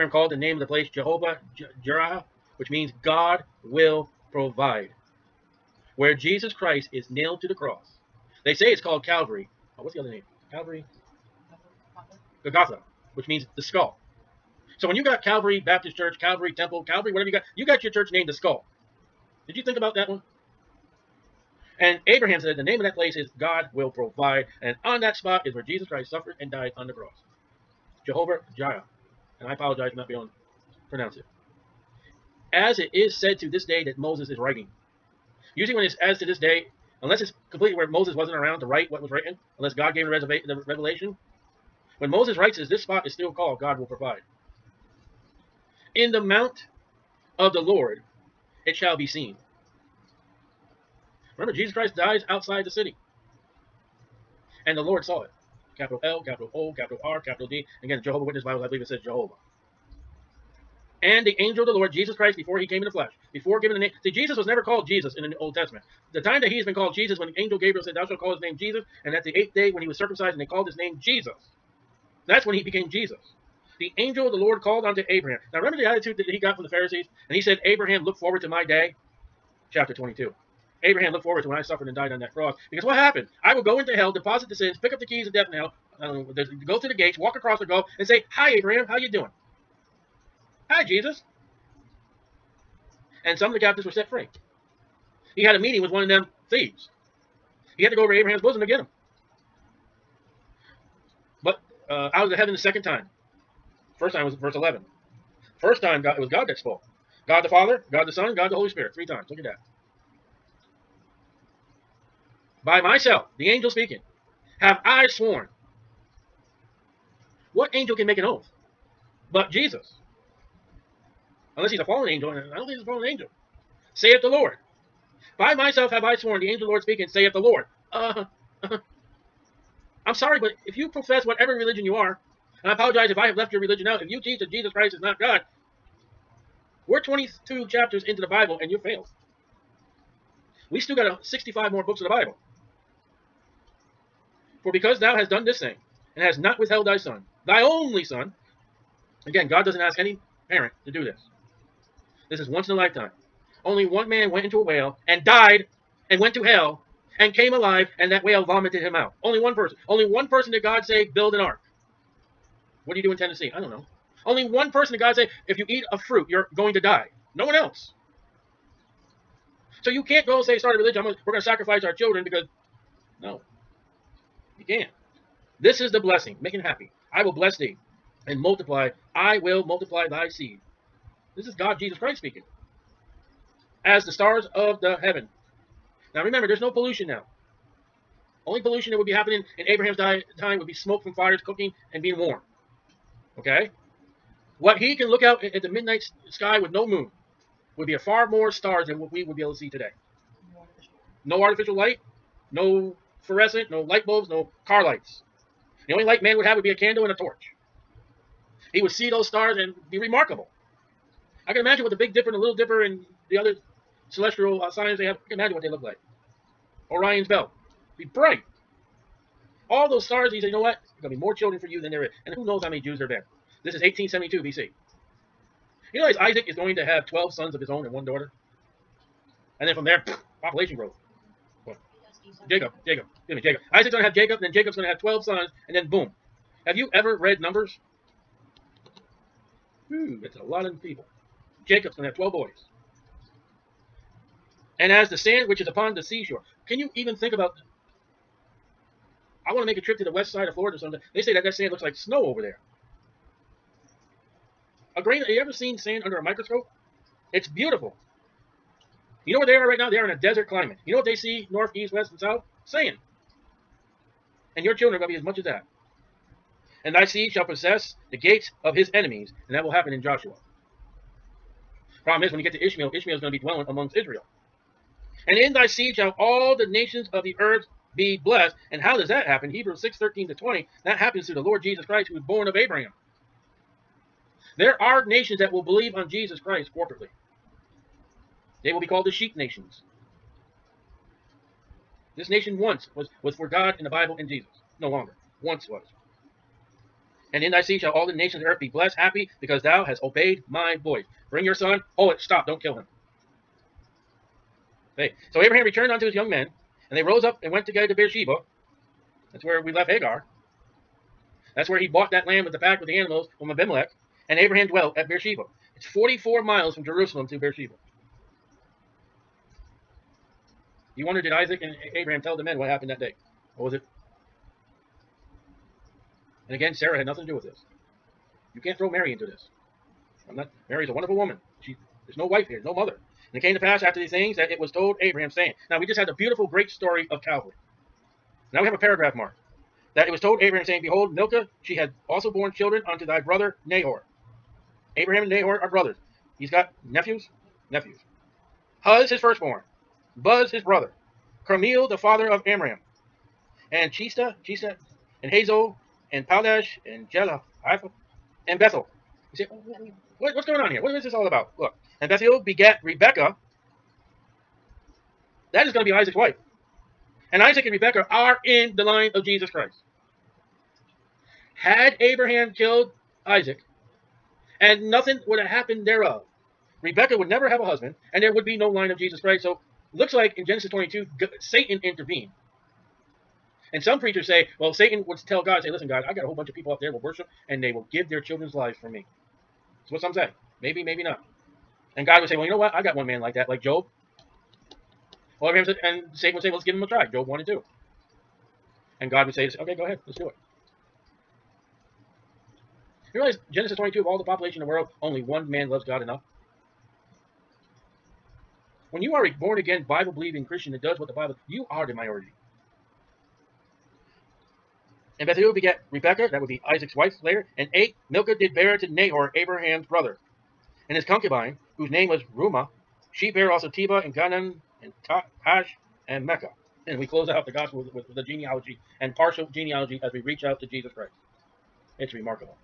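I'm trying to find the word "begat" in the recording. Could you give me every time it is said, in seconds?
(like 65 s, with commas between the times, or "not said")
362 s, 415 s.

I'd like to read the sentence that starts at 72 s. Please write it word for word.
That's when he became Jesus the angel of the Lord called unto Abraham.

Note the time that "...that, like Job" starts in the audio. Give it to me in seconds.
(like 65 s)
393 s.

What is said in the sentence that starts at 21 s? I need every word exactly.
And Abraham said, the name of that place is God will provide.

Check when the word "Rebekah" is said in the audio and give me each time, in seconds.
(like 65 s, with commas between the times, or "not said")
362 s, 367 s, 376 s, 415 s.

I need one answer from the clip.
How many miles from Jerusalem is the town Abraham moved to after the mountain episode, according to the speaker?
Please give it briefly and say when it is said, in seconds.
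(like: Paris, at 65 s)
44, at 315 s.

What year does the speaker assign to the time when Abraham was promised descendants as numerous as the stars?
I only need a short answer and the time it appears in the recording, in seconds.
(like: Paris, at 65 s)
1872 BC, at 223 s.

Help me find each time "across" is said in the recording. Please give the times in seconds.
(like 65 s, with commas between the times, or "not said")
87 s.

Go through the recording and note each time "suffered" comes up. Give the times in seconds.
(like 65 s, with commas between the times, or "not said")
26 s, 81 s.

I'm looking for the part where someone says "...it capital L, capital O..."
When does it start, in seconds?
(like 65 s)
55 s.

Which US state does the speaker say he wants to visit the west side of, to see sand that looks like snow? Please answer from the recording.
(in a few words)
Florida.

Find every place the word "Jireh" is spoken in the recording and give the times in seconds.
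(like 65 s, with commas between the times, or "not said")
1 s, 28 s.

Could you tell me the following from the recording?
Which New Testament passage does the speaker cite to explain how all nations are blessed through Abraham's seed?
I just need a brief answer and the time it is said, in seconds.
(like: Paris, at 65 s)
Hebrews 6:13-20, at 279 s.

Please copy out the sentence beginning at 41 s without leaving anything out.
When Moses writes this, this spot is still called God will provide.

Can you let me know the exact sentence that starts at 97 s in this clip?
He had to go over to Abraham's bosom to get him.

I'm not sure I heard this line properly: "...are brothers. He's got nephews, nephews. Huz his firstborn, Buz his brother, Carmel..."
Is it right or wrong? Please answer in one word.
right.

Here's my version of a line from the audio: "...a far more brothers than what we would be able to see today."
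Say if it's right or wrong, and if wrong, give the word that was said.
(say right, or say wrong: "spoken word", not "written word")
wrong: "stars", not "brothers".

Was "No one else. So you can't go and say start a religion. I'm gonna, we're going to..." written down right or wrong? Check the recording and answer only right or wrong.
right.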